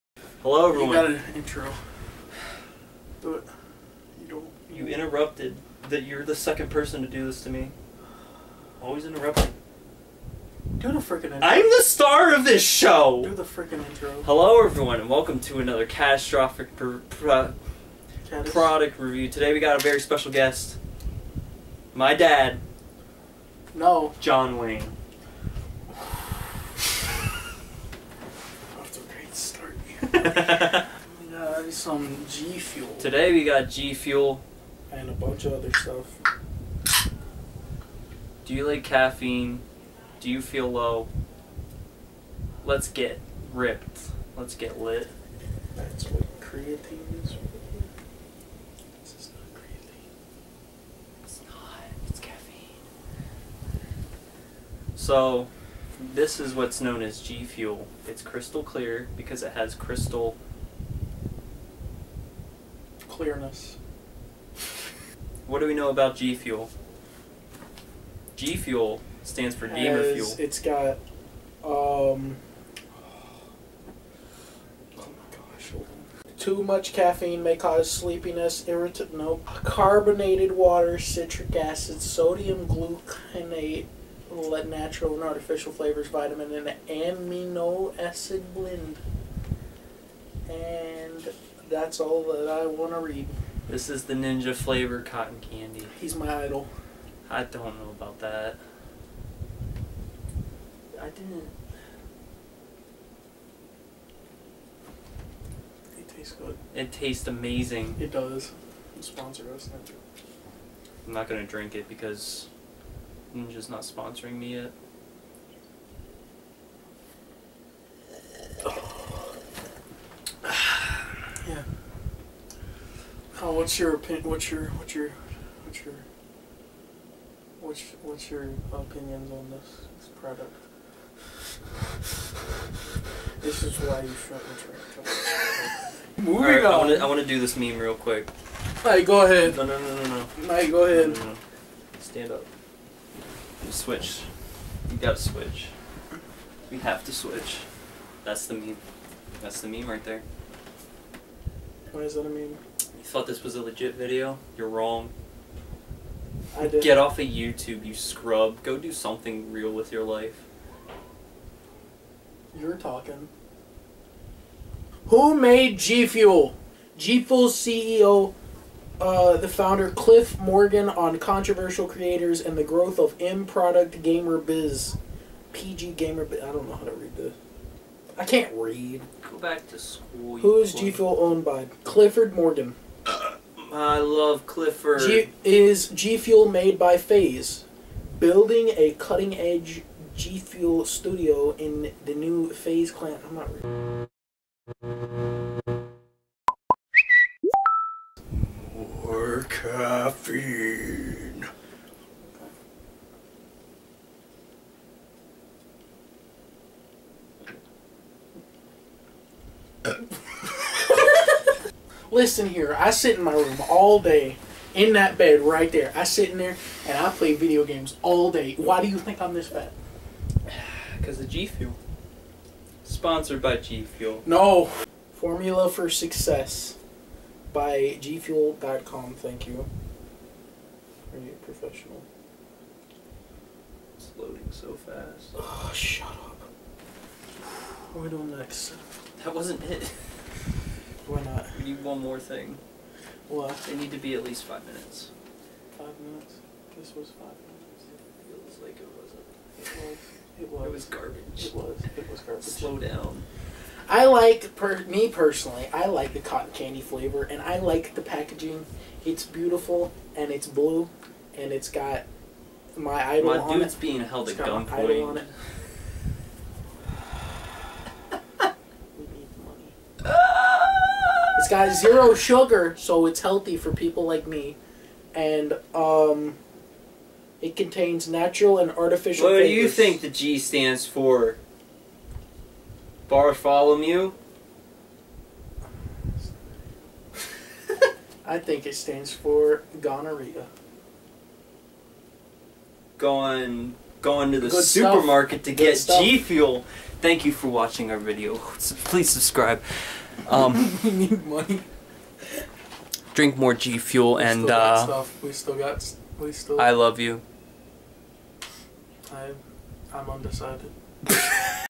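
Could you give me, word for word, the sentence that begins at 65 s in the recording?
What do we know about G Fuel?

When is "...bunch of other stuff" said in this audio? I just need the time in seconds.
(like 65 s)
35 s.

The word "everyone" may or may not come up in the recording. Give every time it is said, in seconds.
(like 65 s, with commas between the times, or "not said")
0 s, 14 s.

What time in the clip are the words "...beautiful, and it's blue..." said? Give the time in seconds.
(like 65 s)
259 s.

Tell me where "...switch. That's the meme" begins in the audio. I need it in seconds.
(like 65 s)
147 s.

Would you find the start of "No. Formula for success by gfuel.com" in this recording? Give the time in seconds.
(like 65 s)
224 s.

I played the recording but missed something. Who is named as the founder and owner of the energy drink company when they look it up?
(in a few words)
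Clifford Morgan.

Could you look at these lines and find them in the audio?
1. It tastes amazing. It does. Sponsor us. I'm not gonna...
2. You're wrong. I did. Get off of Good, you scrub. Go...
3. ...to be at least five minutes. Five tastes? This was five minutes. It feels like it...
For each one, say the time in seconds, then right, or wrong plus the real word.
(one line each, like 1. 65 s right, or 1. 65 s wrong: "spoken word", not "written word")
1. 106 s right
2. 154 s wrong: "YouTube", not "Good"
3. 243 s wrong: "minutes", not "tastes".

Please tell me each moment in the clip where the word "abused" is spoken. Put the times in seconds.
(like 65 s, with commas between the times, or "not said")
not said.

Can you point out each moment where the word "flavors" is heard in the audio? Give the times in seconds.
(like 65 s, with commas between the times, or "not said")
85 s, 94 s, 256 s, 279 s.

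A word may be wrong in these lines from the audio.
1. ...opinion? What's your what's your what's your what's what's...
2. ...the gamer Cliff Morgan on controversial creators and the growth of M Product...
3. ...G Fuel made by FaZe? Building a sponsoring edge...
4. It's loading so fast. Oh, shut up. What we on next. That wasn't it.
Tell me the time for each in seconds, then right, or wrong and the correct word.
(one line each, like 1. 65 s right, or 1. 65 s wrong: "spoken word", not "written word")
1. 123 s right
2. 169 s wrong: "founder", not "gamer"
3. 185 s wrong: "cutting", not "sponsoring"
4. 233 s right.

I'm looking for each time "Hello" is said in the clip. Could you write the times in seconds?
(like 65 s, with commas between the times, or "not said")
0 s, 14 s.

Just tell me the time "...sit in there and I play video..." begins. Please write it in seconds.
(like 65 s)
216 s.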